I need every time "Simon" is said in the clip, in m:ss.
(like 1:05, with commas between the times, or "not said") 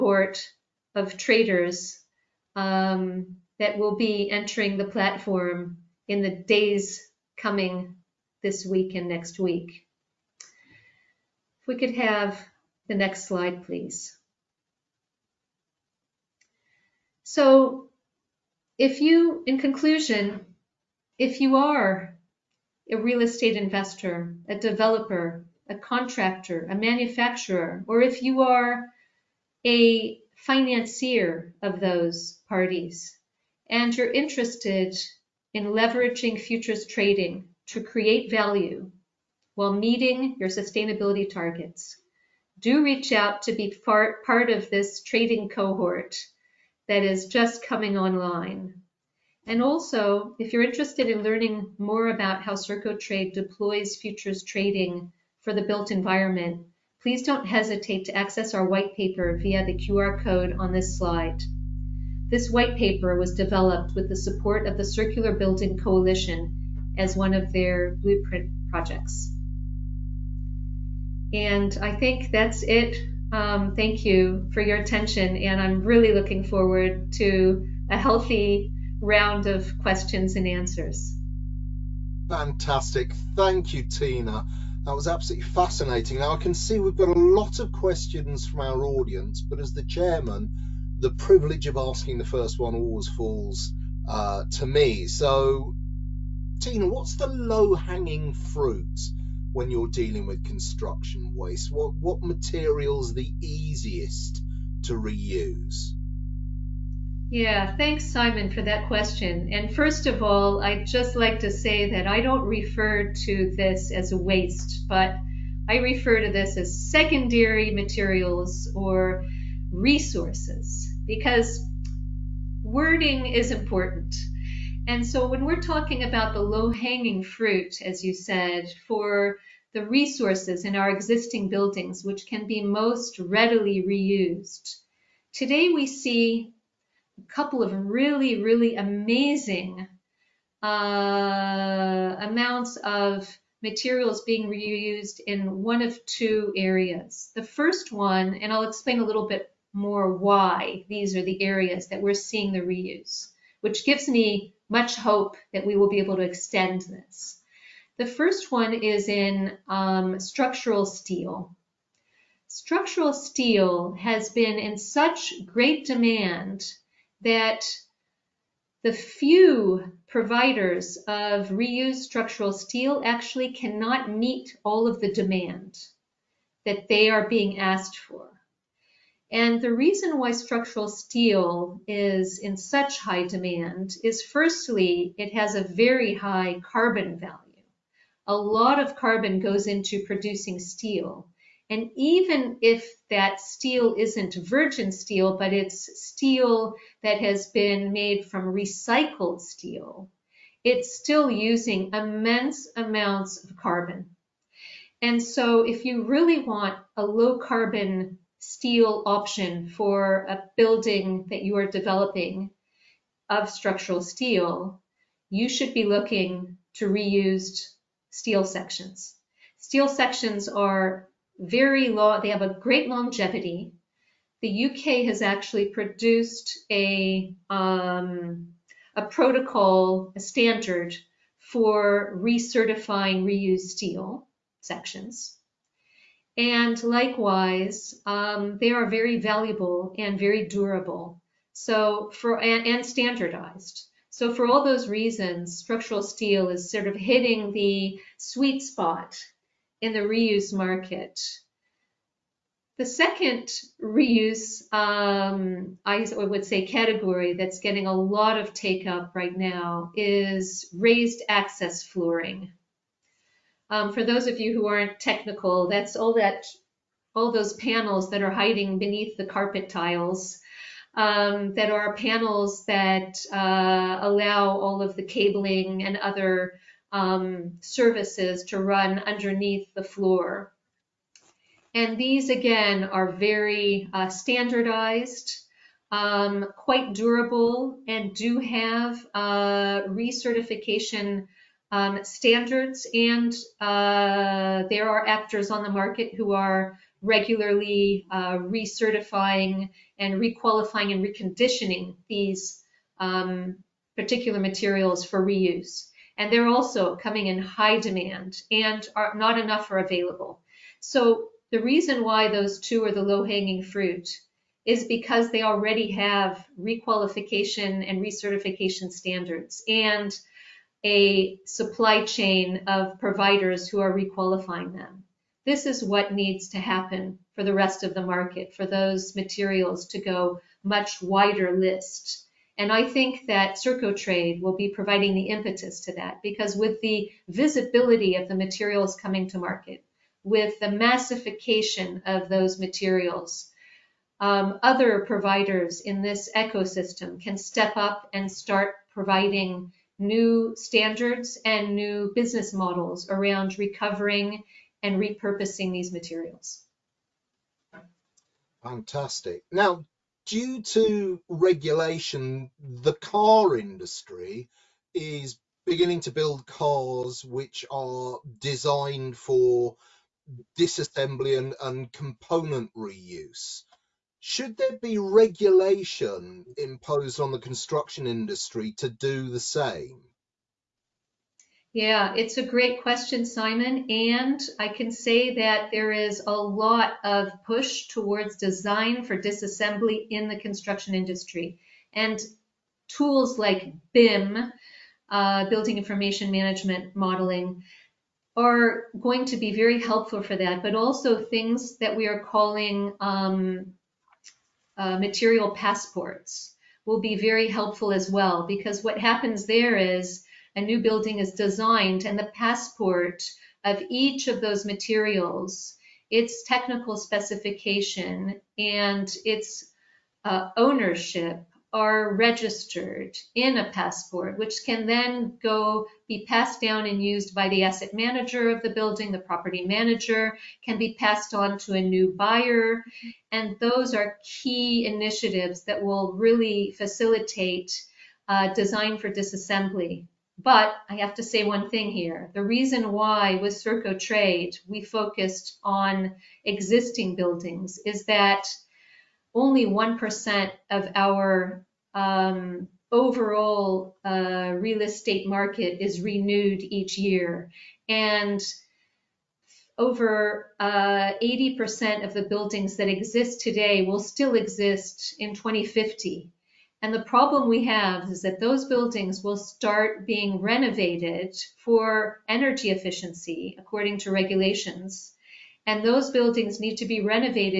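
1:48, 6:23.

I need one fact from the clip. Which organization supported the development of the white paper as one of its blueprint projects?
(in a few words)
Circular Building Coalition.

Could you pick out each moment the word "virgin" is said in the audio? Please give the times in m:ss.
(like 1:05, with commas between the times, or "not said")
3:14.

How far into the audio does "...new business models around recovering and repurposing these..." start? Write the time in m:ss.
5:51.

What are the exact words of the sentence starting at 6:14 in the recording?
Should there be regulation imposed on the construction industry to do the same?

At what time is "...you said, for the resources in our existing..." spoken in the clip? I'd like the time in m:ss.
2:08.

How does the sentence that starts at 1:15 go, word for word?
And I'm really looking forward to a healthy round of questions and answers.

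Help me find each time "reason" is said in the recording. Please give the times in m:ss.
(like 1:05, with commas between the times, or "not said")
2:59, 4:04, 5:11, 7:22.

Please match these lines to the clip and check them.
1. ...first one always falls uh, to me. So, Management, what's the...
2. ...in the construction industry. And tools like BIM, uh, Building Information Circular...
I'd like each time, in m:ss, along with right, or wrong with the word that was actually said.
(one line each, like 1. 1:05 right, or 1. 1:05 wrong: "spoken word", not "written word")
1. 1:32 wrong: "Tina", not "Management"
2. 6:30 wrong: "Management", not "Circular".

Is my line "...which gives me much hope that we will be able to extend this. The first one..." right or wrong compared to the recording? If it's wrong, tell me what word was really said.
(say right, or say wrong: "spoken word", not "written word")
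right.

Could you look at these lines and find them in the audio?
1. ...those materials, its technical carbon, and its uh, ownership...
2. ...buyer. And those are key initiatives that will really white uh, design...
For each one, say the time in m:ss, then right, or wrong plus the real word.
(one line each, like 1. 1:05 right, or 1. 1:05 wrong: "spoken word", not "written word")
1. 6:54 wrong: "specification", not "carbon"
2. 7:12 wrong: "facilitate", not "white".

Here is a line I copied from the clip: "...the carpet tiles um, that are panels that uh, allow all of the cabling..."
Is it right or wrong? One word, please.
right.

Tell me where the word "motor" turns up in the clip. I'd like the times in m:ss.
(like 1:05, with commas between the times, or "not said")
not said.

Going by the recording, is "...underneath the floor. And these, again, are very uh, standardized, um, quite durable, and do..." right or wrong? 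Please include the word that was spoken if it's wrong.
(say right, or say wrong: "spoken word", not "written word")
right.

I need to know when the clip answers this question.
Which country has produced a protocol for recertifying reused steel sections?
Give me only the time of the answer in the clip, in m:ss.
3:44.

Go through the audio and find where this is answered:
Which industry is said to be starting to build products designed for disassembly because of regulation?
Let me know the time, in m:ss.
6:02.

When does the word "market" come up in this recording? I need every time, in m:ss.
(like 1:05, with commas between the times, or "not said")
4:10, 4:55, 5:28, 5:39, 7:35.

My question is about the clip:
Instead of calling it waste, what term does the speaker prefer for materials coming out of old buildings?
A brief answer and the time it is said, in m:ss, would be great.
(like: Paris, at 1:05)
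secondary materials, at 1:56.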